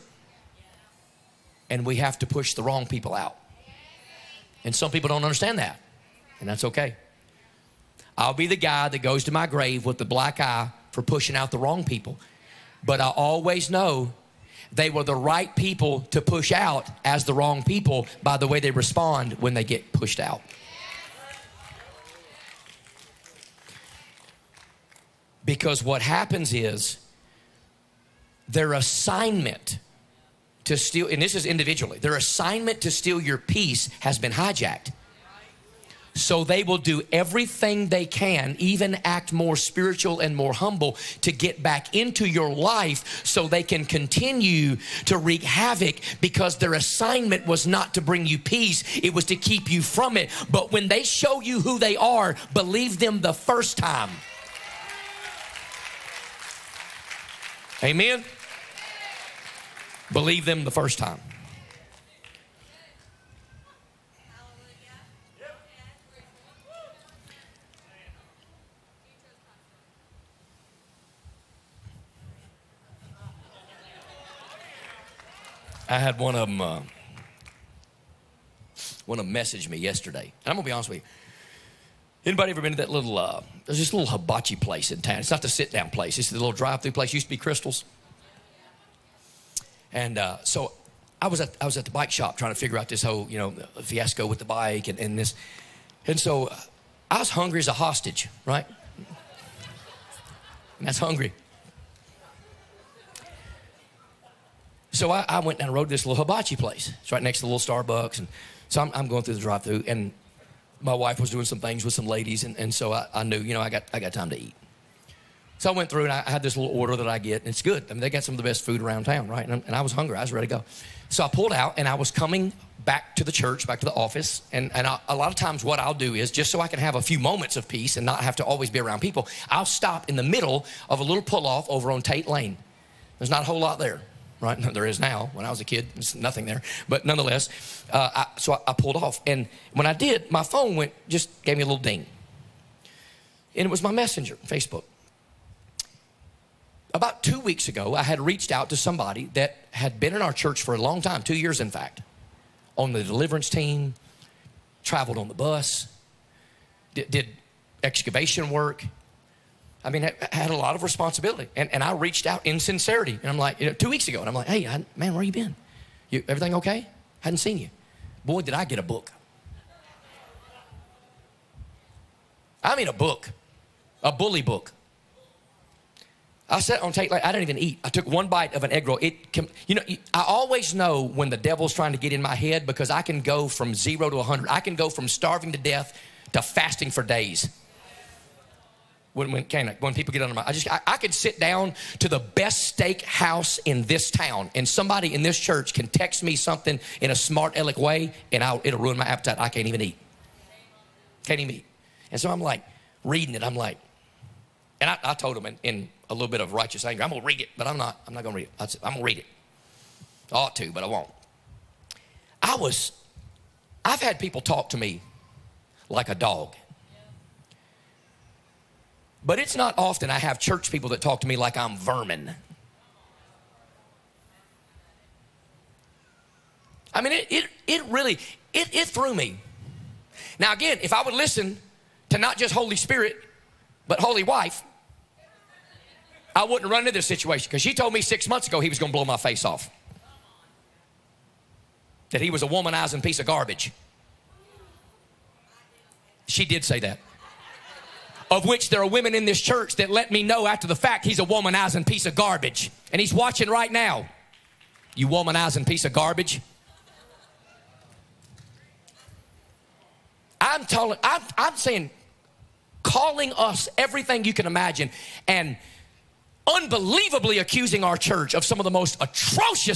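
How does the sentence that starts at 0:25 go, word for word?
Because what happens is their assignment to steal, and this is individually, their assignment to steal your peace has been hijacked.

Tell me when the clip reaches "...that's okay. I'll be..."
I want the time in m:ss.
0:06.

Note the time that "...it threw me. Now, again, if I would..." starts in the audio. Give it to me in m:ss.
3:48.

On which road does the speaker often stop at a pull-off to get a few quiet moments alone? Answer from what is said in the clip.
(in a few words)
Tate Lane.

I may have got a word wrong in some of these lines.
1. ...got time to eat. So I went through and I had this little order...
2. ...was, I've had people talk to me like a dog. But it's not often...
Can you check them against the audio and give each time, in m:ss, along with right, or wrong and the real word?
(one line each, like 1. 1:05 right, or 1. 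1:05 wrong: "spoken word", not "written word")
1. 1:53 right
2. 3:32 right.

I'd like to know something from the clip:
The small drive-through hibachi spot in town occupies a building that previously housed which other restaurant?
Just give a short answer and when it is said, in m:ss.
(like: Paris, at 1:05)
Krystals, at 1:27.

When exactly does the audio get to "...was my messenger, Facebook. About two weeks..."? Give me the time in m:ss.
2:23.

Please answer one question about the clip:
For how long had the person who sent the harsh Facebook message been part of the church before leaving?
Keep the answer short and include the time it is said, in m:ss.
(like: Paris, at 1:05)
2 years, at 2:31.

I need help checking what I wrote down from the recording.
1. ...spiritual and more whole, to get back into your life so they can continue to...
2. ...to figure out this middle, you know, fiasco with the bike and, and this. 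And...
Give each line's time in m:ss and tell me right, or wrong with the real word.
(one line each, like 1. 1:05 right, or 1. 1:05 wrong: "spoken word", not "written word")
1. 0:39 wrong: "humble", not "whole"
2. 1:32 wrong: "whole", not "middle".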